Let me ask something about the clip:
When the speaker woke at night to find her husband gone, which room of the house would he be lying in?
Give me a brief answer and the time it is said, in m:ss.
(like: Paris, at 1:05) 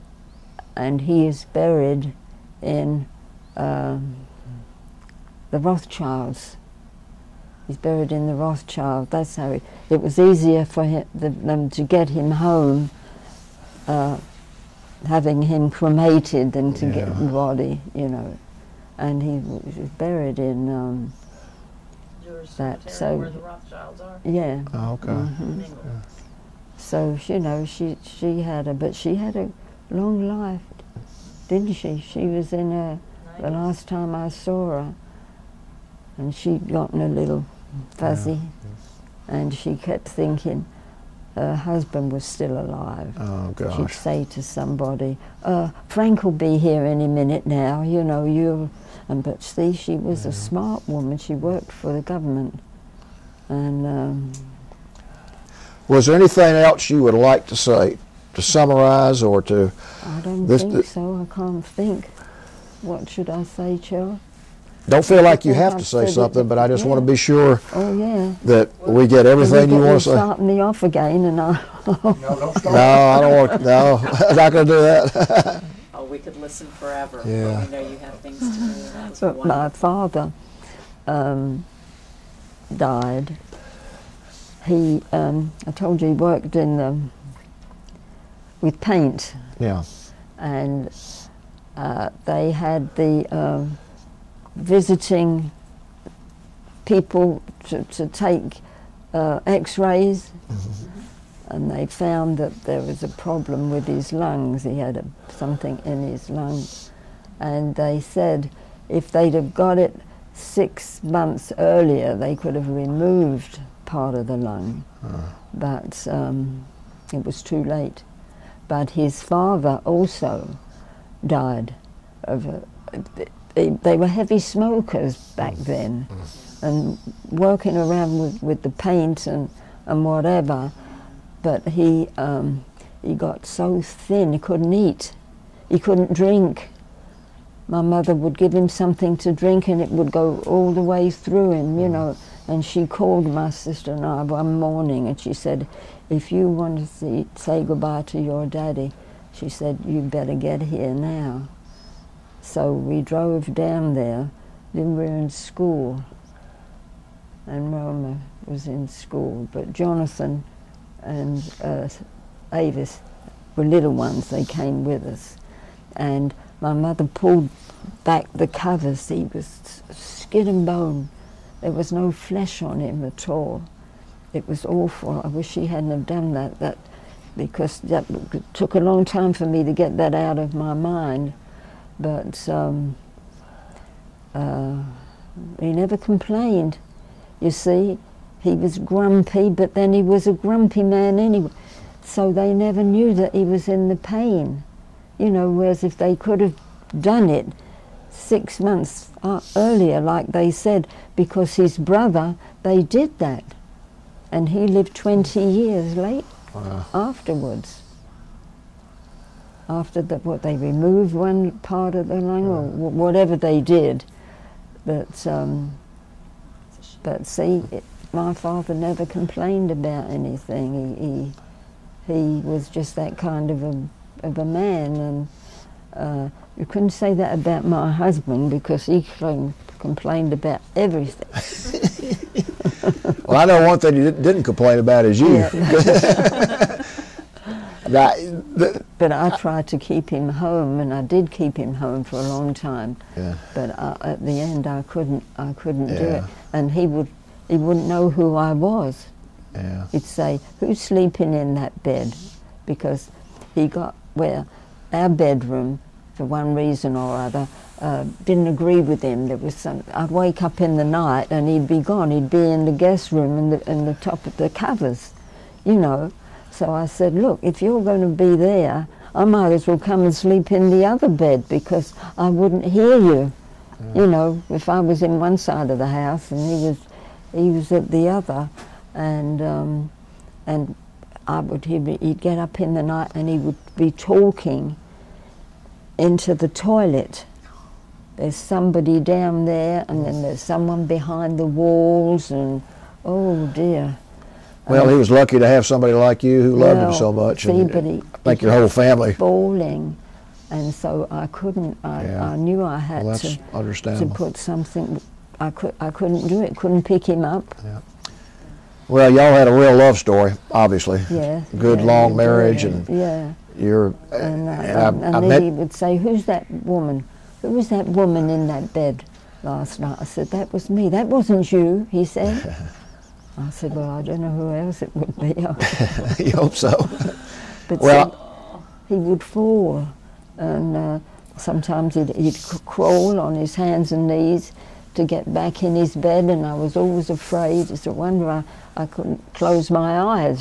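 The guest room, at 4:22.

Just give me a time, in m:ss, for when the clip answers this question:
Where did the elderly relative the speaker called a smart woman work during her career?
0:51.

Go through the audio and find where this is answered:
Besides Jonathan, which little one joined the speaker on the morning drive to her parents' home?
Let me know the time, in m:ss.
2:42.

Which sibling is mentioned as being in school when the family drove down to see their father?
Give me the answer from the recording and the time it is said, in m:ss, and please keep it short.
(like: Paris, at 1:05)
Roma, at 2:37.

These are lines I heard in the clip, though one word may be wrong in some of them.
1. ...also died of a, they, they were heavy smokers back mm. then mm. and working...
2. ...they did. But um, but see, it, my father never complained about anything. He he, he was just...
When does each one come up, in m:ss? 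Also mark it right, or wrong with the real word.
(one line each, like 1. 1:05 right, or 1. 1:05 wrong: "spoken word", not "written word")
1. 1:59 right
2. 3:33 right.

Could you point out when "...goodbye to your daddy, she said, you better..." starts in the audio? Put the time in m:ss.
2:27.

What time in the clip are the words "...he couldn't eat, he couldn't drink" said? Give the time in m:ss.
2:14.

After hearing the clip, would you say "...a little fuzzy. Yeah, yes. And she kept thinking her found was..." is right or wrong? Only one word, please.
wrong.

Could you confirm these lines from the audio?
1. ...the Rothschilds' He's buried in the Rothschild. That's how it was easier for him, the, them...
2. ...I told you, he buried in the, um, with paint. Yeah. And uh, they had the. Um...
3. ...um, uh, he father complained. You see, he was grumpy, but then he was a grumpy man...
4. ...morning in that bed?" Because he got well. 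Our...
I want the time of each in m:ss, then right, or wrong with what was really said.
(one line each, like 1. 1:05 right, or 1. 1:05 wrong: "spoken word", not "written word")
1. 0:05 right
2. 1:25 wrong: "worked", not "buried"
3. 3:02 wrong: "never", not "father"
4. 4:10 wrong: "sleeping", not "morning".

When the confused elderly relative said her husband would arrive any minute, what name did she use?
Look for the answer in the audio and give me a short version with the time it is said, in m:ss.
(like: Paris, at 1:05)
Frank, at 0:45.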